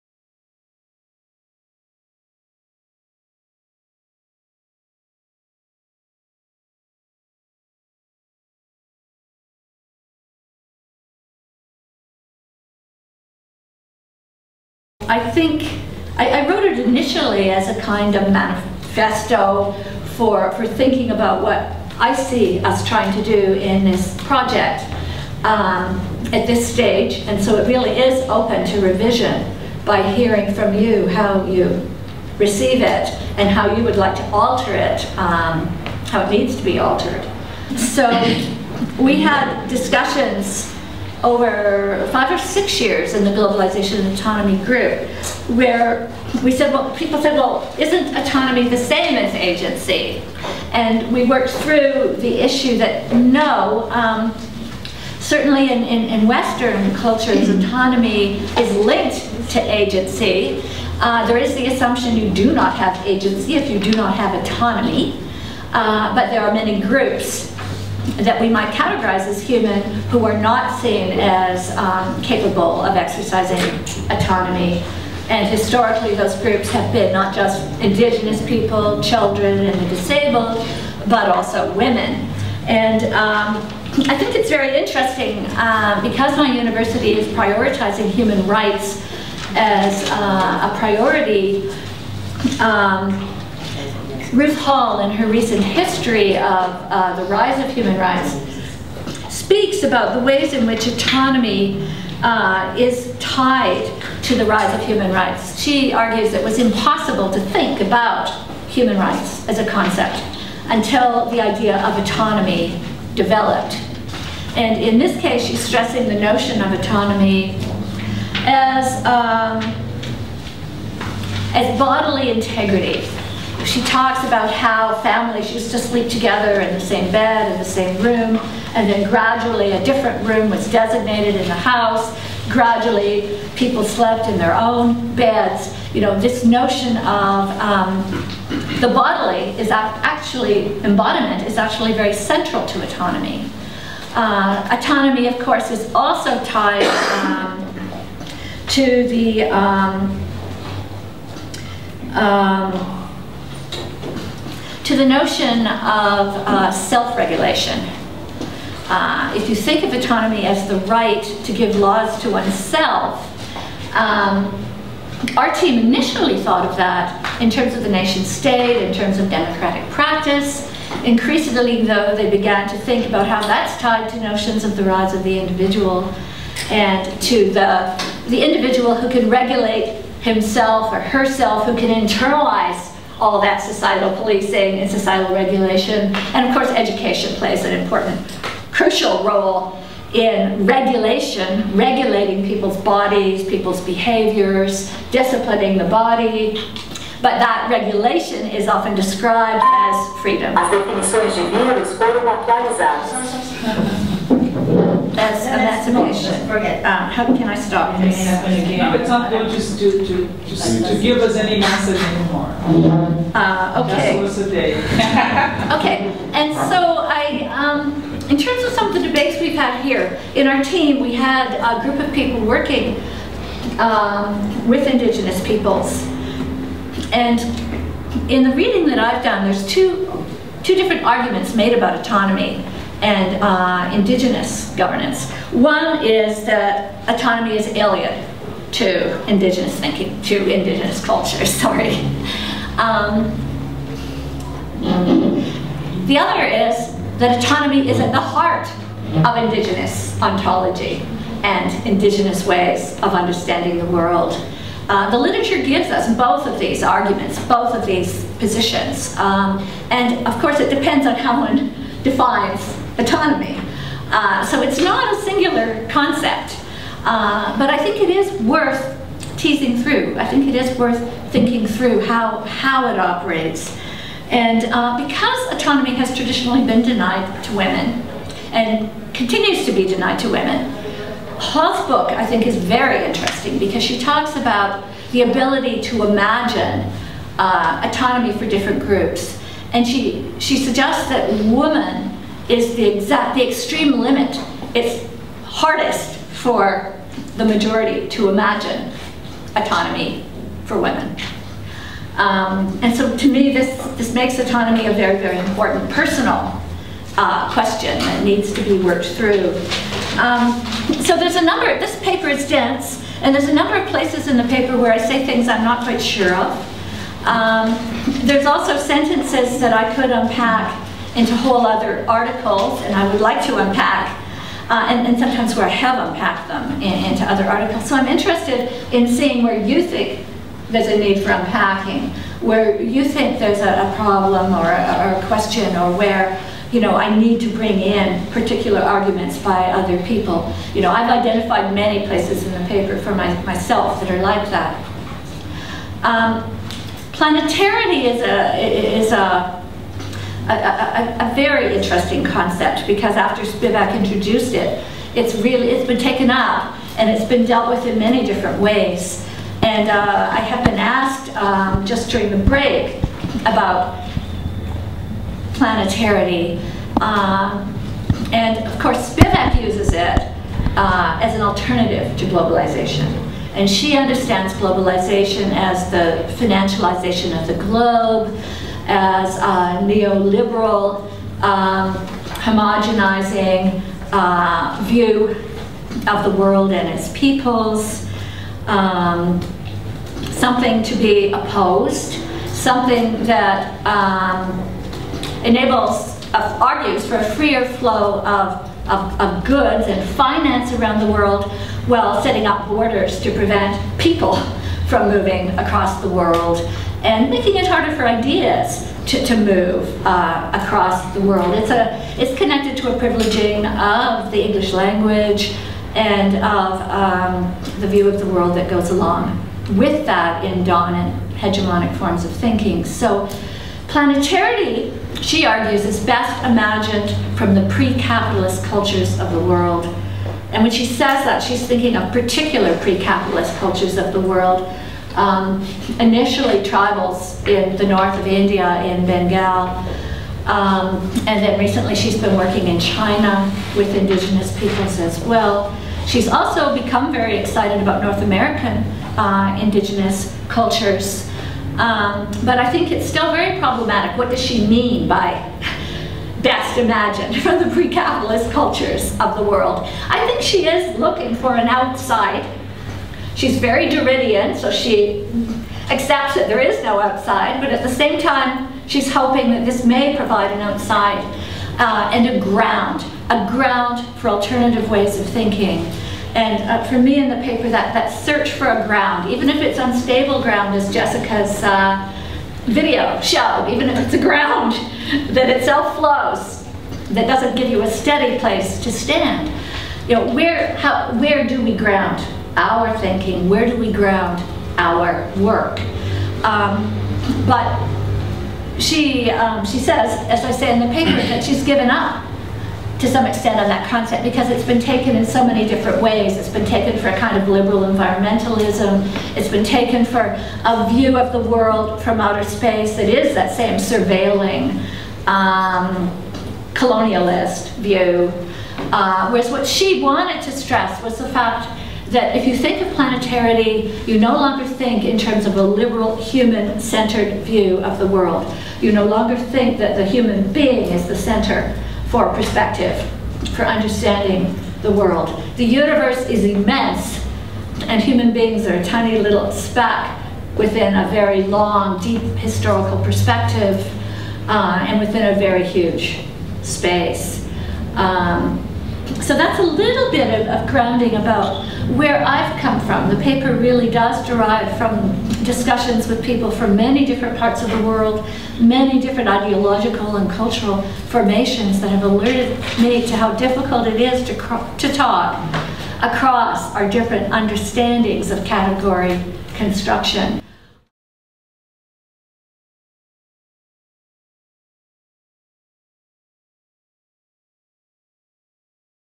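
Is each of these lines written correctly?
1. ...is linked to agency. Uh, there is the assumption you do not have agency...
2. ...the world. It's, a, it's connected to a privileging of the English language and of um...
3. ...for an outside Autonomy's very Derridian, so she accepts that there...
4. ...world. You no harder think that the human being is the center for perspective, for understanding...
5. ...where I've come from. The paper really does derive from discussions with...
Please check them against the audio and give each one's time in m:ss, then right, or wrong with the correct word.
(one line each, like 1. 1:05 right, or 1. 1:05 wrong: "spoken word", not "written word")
1. 0:58 right
2. 6:51 right
3. 7:41 wrong: "She", not "Autonomy"
4. 8:48 wrong: "longer", not "harder"
5. 9:11 right.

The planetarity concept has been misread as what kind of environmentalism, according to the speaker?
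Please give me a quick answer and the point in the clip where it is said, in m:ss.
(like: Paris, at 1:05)
liberal environmentalism, at 8:27.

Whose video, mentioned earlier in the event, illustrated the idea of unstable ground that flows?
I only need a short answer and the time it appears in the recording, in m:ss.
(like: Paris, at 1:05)
Jessica, at 8:00.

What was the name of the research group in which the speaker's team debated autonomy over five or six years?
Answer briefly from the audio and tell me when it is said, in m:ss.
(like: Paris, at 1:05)
Globalization and Autonomy, at 0:43.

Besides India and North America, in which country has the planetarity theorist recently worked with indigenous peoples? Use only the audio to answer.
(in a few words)
China.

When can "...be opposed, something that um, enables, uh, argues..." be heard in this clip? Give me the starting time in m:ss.
6:30.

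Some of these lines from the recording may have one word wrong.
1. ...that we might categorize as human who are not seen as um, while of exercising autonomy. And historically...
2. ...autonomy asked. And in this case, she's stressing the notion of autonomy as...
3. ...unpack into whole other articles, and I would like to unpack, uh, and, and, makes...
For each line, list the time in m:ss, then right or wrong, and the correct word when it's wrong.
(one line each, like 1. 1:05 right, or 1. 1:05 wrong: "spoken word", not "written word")
1. 1:08 wrong: "capable", not "while"
2. 1:52 wrong: "developed", not "asked"
3. 5:20 wrong: "sometimes", not "makes".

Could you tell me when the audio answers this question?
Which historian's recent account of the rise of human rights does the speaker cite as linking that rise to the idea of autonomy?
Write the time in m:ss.
1:34.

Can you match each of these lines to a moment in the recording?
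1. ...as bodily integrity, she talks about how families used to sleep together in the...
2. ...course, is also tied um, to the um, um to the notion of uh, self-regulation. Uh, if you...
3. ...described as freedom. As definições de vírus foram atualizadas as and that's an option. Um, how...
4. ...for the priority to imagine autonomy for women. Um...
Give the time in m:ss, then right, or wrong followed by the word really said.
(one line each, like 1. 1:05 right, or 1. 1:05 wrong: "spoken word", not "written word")
1. 2:01 right
2. 2:25 right
3. 3:18 right
4. 4:56 wrong: "majority", not "priority".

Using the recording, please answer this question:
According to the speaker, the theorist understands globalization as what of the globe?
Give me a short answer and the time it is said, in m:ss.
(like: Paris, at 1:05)
financialization, at 6:16.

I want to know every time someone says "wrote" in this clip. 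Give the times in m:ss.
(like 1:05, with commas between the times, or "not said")
0:16.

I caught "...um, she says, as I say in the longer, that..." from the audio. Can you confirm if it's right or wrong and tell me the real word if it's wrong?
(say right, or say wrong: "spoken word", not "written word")
wrong: "paper", not "longer".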